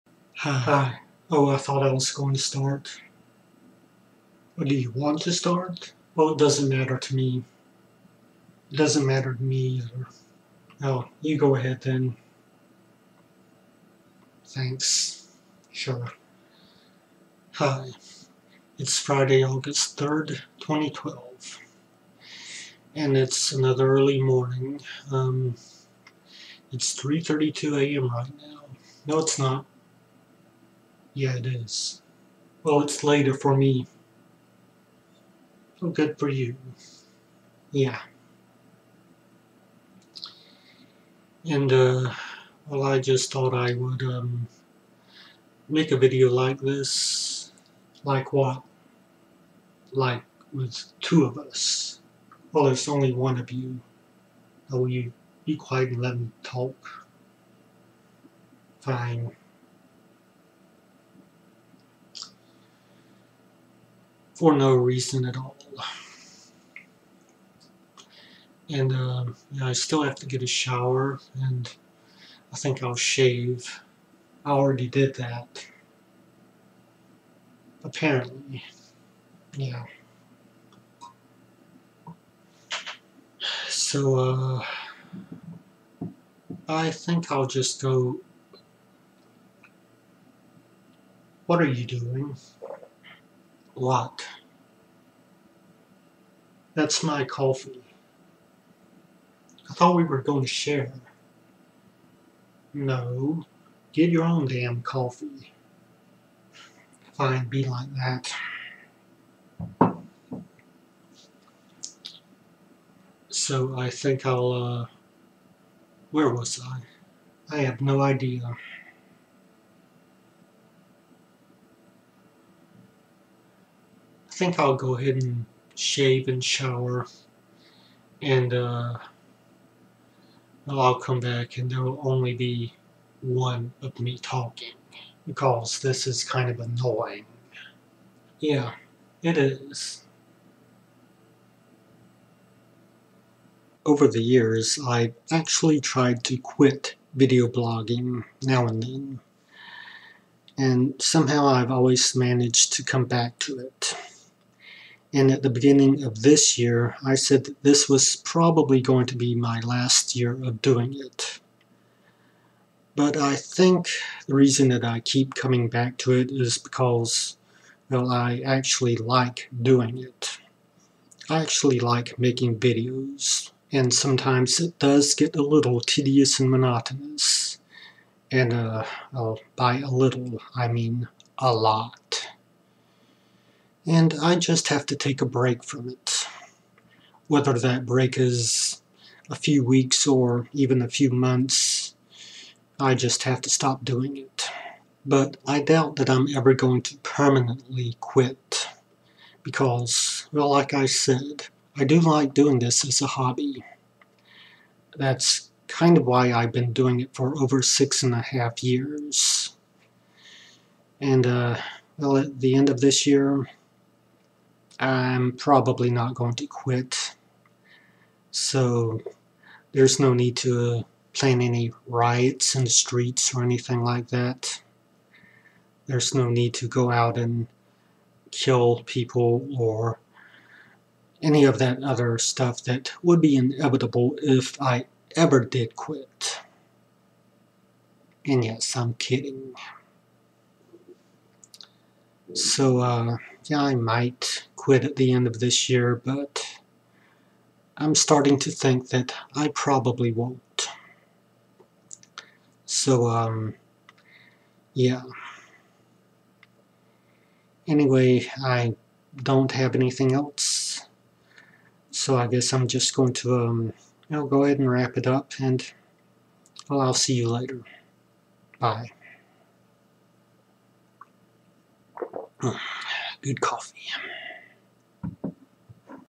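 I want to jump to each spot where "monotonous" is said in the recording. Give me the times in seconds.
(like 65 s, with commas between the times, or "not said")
176 s.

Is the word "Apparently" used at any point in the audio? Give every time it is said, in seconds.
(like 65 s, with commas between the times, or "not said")
77 s.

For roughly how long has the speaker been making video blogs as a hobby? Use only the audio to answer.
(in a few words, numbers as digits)
Over six and a half years.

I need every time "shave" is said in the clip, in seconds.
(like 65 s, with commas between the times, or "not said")
72 s, 125 s.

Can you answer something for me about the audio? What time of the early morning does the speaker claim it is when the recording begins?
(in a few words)
3:32 a.m.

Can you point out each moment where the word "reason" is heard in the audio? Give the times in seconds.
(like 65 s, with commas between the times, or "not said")
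64 s, 164 s.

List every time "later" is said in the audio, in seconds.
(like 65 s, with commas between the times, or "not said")
33 s, 267 s.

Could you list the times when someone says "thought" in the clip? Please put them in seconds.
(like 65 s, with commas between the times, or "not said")
1 s, 43 s, 99 s.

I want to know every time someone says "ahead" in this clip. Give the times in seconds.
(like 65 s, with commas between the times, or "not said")
11 s, 124 s, 264 s.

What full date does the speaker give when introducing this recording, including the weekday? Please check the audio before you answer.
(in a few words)
Friday, August 3rd, 2012.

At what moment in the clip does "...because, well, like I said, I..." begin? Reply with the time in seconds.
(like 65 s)
199 s.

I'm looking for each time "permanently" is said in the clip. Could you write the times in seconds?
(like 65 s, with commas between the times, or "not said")
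196 s.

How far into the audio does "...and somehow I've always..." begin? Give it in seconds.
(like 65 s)
150 s.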